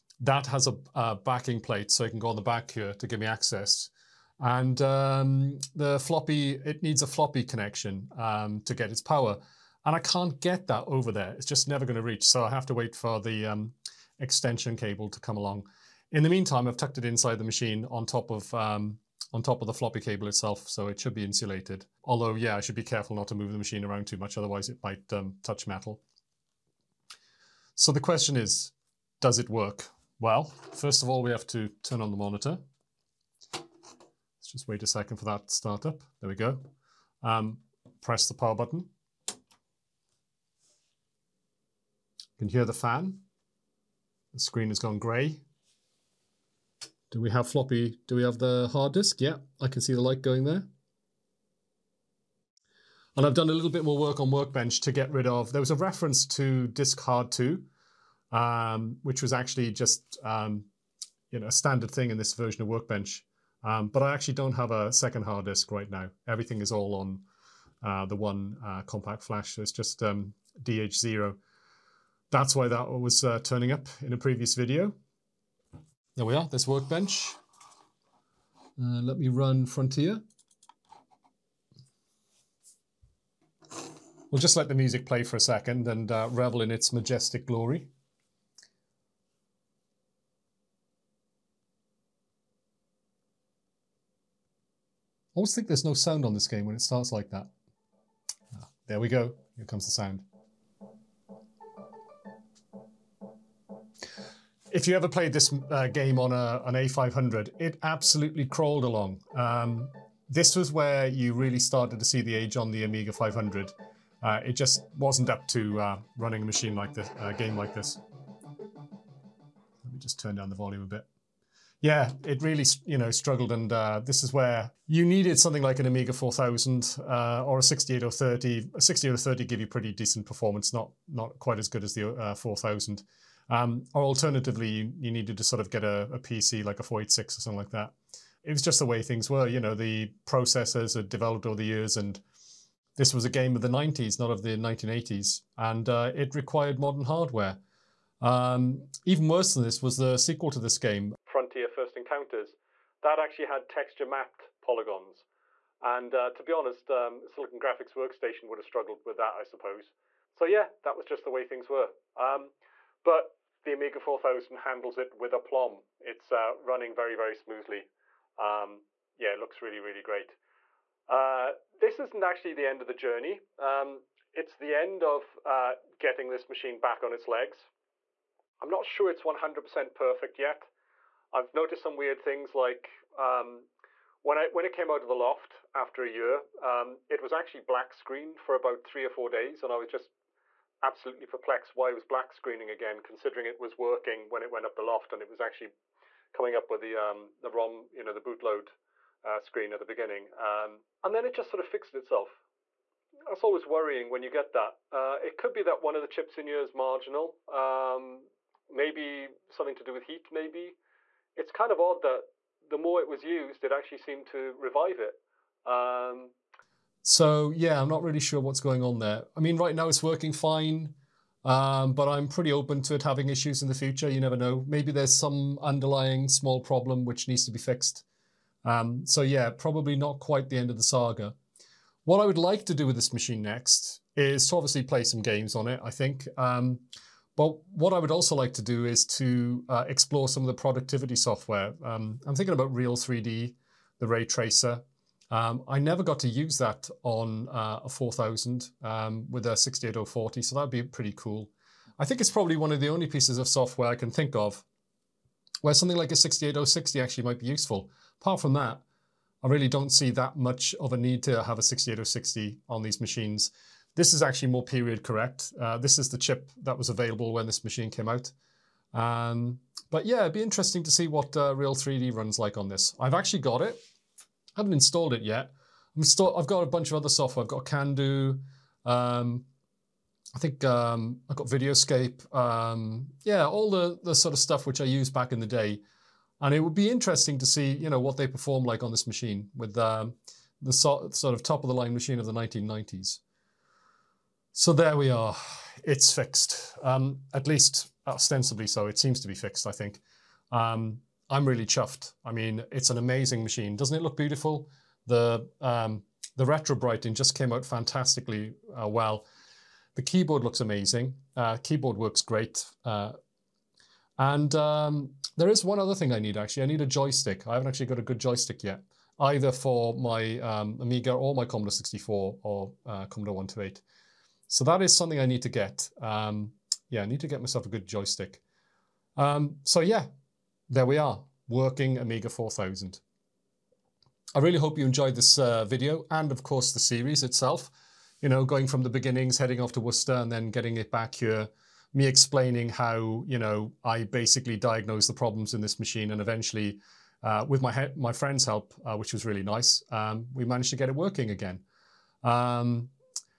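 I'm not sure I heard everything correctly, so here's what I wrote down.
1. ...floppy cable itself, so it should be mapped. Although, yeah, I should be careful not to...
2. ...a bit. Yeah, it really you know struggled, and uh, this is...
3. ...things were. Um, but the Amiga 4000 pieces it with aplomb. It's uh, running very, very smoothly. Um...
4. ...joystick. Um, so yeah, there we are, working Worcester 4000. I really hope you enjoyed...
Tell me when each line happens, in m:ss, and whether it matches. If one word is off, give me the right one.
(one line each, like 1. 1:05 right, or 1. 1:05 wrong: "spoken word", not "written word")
1. 0:19 wrong: "insulated", not "mapped"
2. 2:00 right
3. 2:41 wrong: "handles", not "pieces"
4. 5:27 wrong: "Amiga", not "Worcester".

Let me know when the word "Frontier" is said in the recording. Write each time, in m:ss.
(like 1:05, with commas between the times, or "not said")
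1:19, 2:31.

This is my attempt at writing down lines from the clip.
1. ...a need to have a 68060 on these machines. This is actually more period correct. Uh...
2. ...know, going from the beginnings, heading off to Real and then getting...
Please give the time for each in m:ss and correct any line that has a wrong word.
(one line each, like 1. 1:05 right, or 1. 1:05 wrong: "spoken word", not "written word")
1. 4:20 right
2. 5:38 wrong: "Worcester", not "Real".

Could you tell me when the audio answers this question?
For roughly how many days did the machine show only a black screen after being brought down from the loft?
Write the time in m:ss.
3:08.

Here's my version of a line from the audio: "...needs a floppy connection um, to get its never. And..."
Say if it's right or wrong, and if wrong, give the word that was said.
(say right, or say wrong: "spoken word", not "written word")
wrong: "power", not "never".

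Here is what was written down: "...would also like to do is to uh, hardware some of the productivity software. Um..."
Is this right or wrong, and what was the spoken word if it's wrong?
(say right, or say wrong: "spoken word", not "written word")
wrong: "explore", not "hardware".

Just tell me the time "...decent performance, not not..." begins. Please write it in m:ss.
2:09.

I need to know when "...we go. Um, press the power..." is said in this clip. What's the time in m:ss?
0:36.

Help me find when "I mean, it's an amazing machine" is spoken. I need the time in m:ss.
5:02.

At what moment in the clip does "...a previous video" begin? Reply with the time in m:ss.
1:14.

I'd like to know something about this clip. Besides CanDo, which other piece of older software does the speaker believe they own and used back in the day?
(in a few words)
Videoscape.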